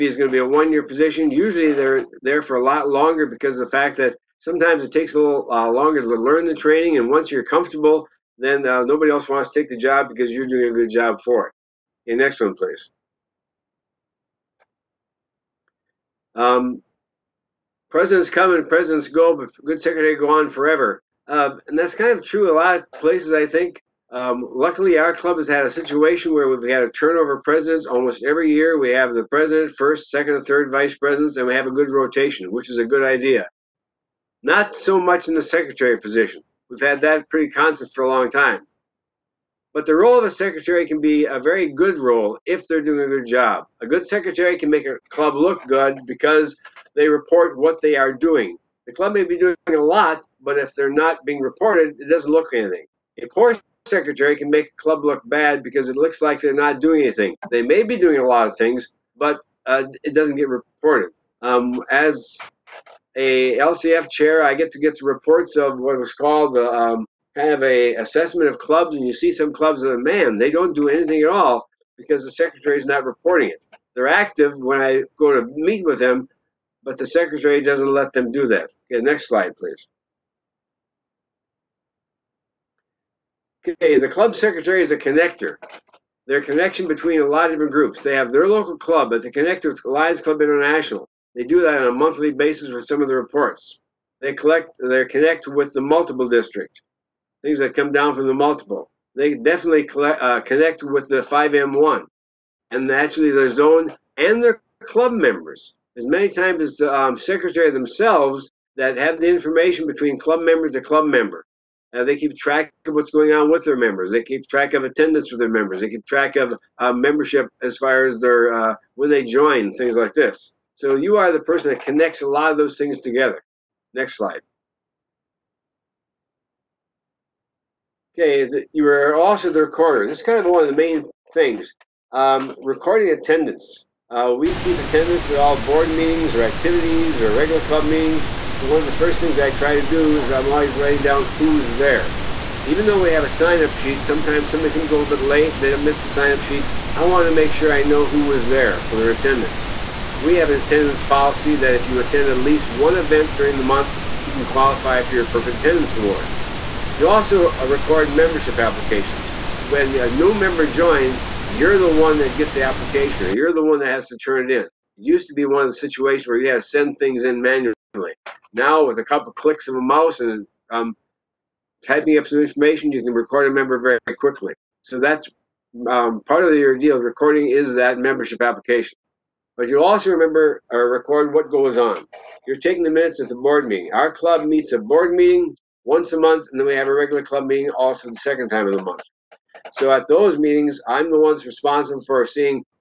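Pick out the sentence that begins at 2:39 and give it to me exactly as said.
When a new member joins, you're the one that gets the application or you're the one that has to turn it in.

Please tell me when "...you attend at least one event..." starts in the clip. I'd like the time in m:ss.
2:31.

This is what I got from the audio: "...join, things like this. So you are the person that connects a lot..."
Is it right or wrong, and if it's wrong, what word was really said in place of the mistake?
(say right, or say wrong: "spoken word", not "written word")
right.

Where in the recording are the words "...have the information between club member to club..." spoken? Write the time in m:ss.
1:48.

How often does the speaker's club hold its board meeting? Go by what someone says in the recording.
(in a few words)
once a month.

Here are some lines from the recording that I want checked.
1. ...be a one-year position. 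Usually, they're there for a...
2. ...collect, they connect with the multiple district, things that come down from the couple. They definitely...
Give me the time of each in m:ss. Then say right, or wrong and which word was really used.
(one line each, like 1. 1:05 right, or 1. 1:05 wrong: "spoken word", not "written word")
1. 0:00 right
2. 1:34 wrong: "multiple", not "couple".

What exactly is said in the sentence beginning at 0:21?
Uh, and that's kind of true a lot of places, I think.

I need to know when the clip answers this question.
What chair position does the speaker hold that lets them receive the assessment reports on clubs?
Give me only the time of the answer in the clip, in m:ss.
1:03.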